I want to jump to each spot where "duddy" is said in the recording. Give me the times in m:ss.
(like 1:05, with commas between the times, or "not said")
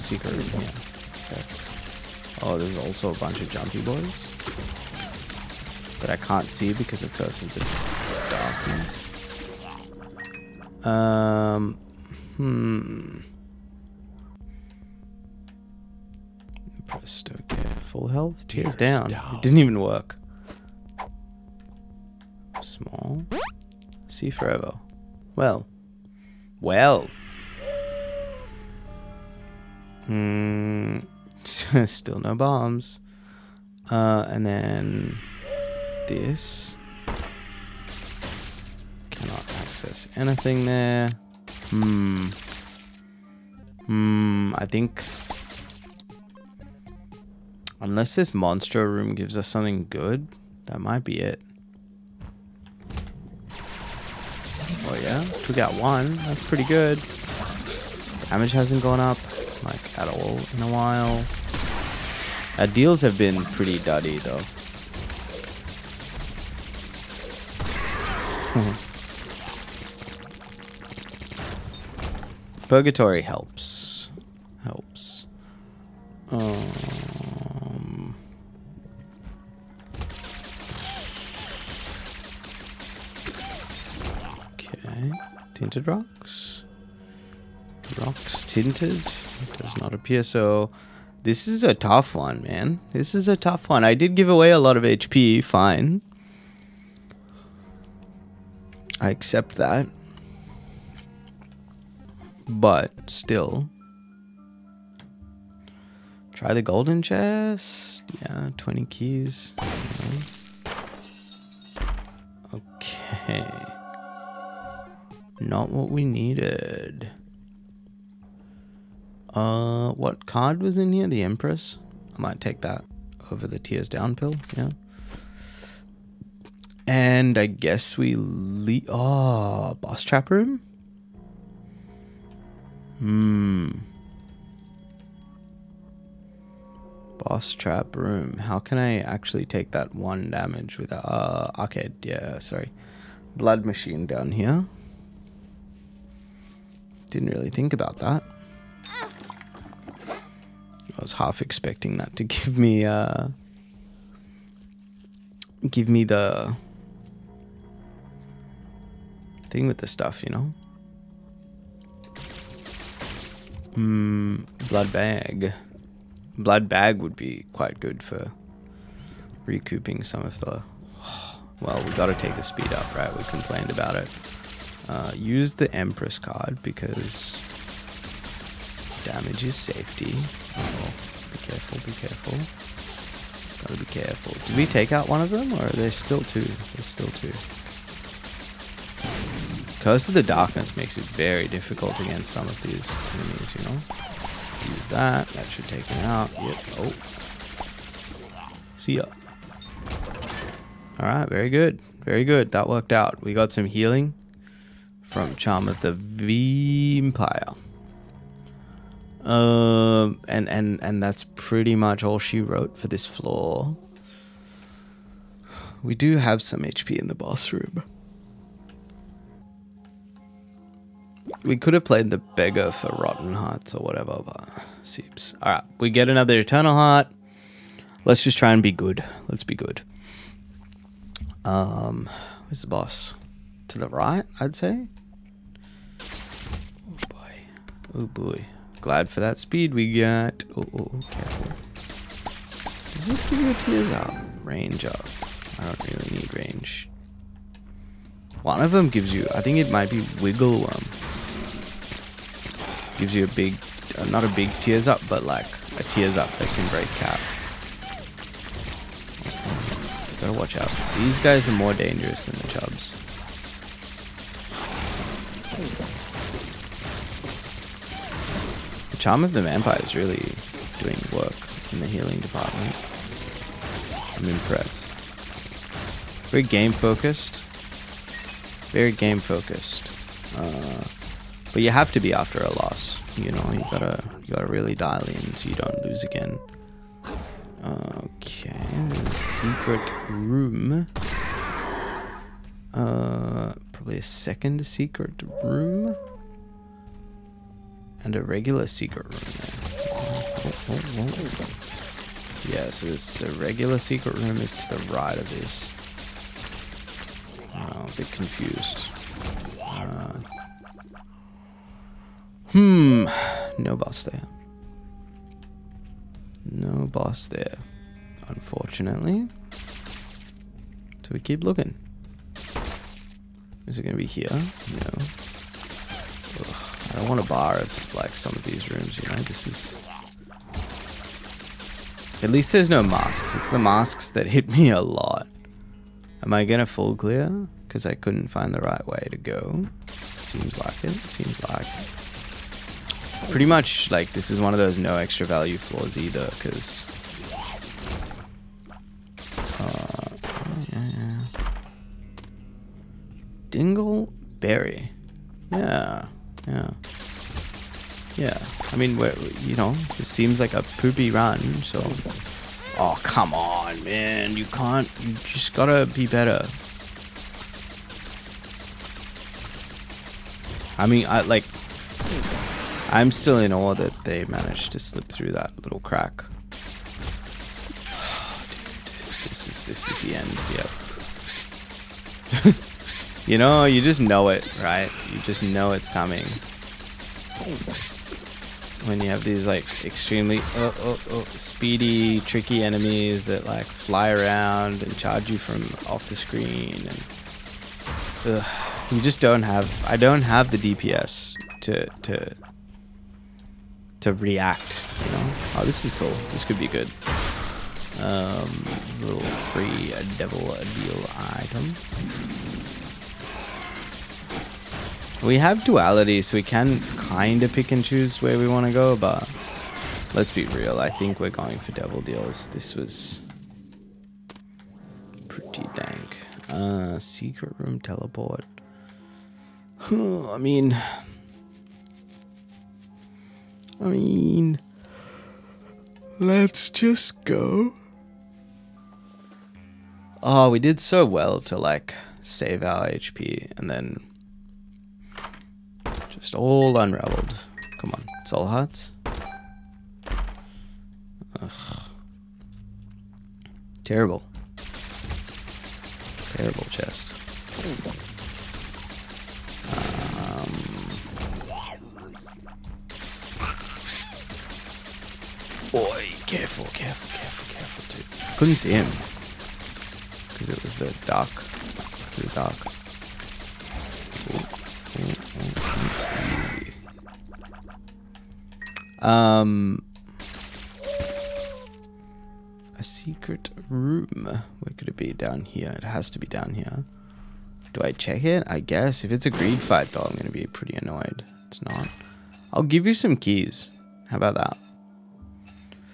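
1:03.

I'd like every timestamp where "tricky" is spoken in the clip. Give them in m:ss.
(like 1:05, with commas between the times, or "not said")
6:32.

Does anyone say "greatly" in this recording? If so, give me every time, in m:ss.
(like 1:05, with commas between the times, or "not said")
not said.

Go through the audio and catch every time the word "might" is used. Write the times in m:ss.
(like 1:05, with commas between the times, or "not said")
0:50, 2:02, 4:09.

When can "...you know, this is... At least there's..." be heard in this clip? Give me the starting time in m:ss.
5:29.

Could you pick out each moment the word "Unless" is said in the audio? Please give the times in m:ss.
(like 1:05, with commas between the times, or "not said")
0:47.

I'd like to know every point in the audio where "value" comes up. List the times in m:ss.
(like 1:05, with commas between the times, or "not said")
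5:45.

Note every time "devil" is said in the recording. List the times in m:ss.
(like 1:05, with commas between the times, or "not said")
6:50, 7:01.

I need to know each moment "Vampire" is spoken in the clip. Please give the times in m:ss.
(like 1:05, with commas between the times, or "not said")
3:25, 4:29.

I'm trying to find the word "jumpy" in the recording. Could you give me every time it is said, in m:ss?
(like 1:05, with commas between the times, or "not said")
0:03.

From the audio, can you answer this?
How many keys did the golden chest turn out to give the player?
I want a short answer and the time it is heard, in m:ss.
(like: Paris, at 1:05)
20, at 1:48.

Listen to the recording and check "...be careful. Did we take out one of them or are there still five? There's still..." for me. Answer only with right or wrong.
wrong.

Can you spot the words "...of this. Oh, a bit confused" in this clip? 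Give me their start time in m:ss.
5:05.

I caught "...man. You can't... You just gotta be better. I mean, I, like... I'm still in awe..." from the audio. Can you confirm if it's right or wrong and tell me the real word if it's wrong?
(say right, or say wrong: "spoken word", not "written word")
right.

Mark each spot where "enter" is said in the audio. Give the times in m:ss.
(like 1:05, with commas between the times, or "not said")
not said.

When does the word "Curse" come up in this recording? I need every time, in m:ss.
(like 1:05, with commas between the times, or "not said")
0:07, 3:09.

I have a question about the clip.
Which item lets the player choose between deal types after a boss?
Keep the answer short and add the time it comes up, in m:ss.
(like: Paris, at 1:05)
Duality, at 6:55.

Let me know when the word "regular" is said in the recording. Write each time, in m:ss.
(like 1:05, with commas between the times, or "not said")
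4:58, 5:03.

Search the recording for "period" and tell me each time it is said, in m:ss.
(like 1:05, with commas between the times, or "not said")
not said.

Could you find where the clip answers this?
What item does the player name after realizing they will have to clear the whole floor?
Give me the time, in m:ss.
5:53.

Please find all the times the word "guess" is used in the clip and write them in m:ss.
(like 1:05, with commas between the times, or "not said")
2:07, 8:08.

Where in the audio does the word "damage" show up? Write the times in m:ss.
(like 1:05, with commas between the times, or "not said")
0:58, 2:20, 2:59.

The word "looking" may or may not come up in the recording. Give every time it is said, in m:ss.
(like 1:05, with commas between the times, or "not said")
5:21.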